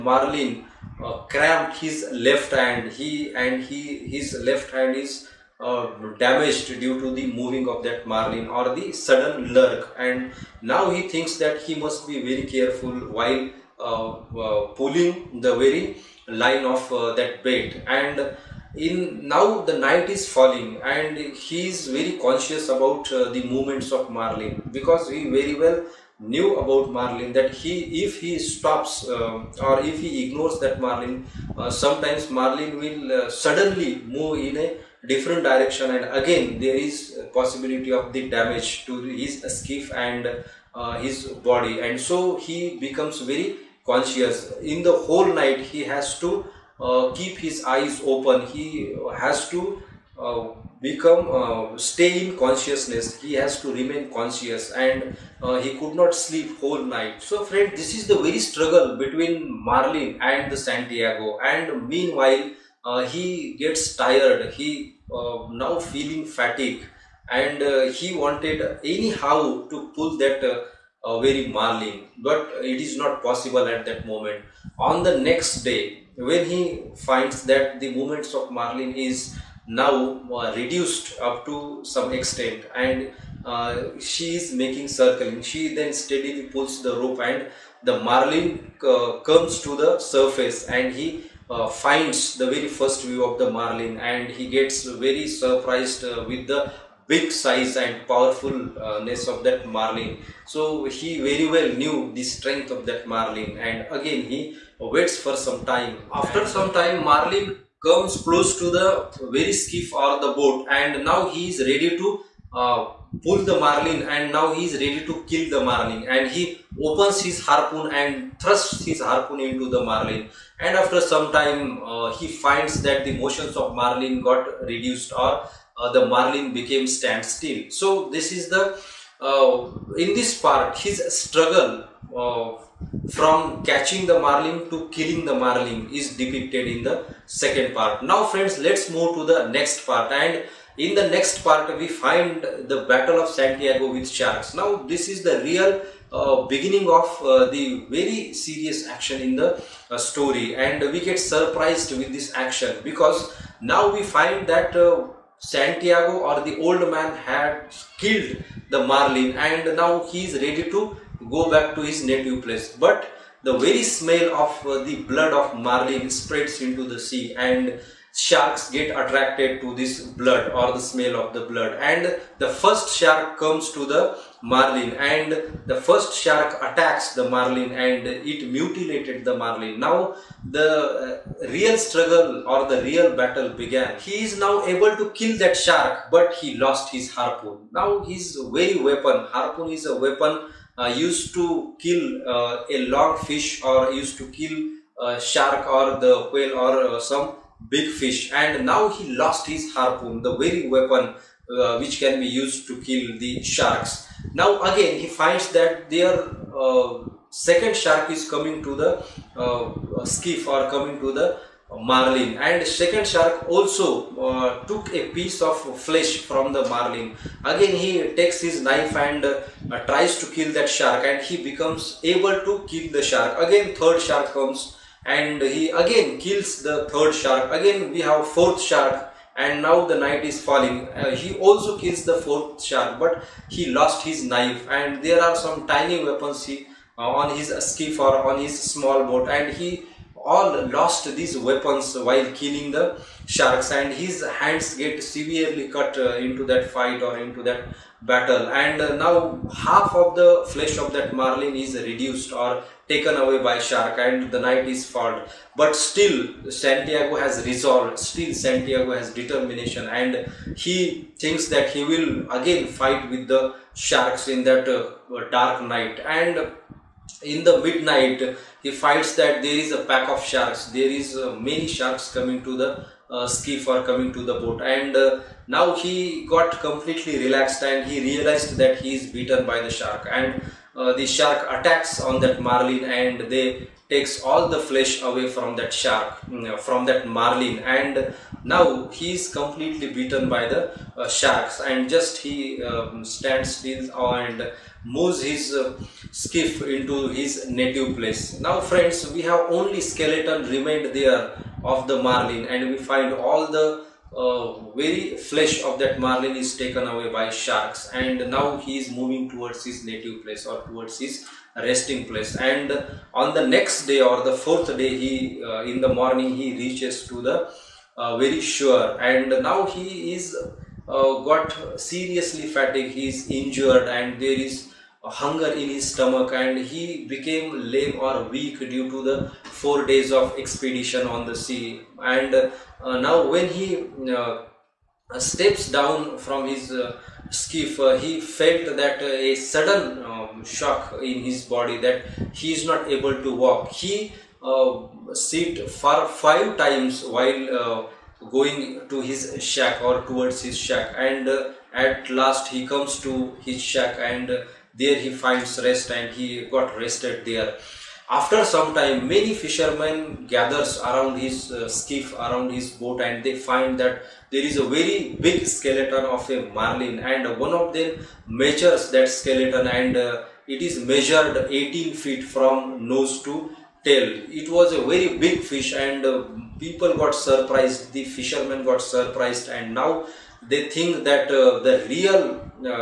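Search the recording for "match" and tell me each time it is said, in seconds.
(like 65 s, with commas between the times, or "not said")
not said.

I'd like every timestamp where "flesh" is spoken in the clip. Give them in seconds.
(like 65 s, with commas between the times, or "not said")
215 s, 250 s, 284 s, 305 s.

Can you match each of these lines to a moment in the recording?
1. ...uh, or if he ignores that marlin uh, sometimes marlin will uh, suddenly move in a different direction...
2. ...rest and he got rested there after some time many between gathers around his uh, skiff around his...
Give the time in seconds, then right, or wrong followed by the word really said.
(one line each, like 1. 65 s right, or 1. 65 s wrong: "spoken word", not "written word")
1. 29 s right
2. 355 s wrong: "fishermen", not "between".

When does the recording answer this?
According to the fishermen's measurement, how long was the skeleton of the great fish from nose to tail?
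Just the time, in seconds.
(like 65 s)
371 s.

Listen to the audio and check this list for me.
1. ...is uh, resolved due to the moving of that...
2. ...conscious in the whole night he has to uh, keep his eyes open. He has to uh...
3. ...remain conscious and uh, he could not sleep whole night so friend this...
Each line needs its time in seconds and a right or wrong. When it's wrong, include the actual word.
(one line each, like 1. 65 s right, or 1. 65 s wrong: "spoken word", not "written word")
1. 4 s wrong: "damaged", not "resolved"
2. 43 s right
3. 53 s right.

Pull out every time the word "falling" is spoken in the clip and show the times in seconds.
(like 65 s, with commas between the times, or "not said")
20 s, 230 s.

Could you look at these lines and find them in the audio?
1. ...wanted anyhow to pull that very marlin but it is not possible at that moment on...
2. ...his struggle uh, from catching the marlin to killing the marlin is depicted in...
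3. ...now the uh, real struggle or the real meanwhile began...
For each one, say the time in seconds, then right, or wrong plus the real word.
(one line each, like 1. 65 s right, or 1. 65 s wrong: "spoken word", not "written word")
1. 68 s right
2. 130 s right
3. 179 s wrong: "battle", not "meanwhile".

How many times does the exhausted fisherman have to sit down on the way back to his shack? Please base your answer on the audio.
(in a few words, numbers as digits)
5.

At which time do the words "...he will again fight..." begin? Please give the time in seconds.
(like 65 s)
261 s.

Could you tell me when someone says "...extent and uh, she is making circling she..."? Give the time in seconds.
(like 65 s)
82 s.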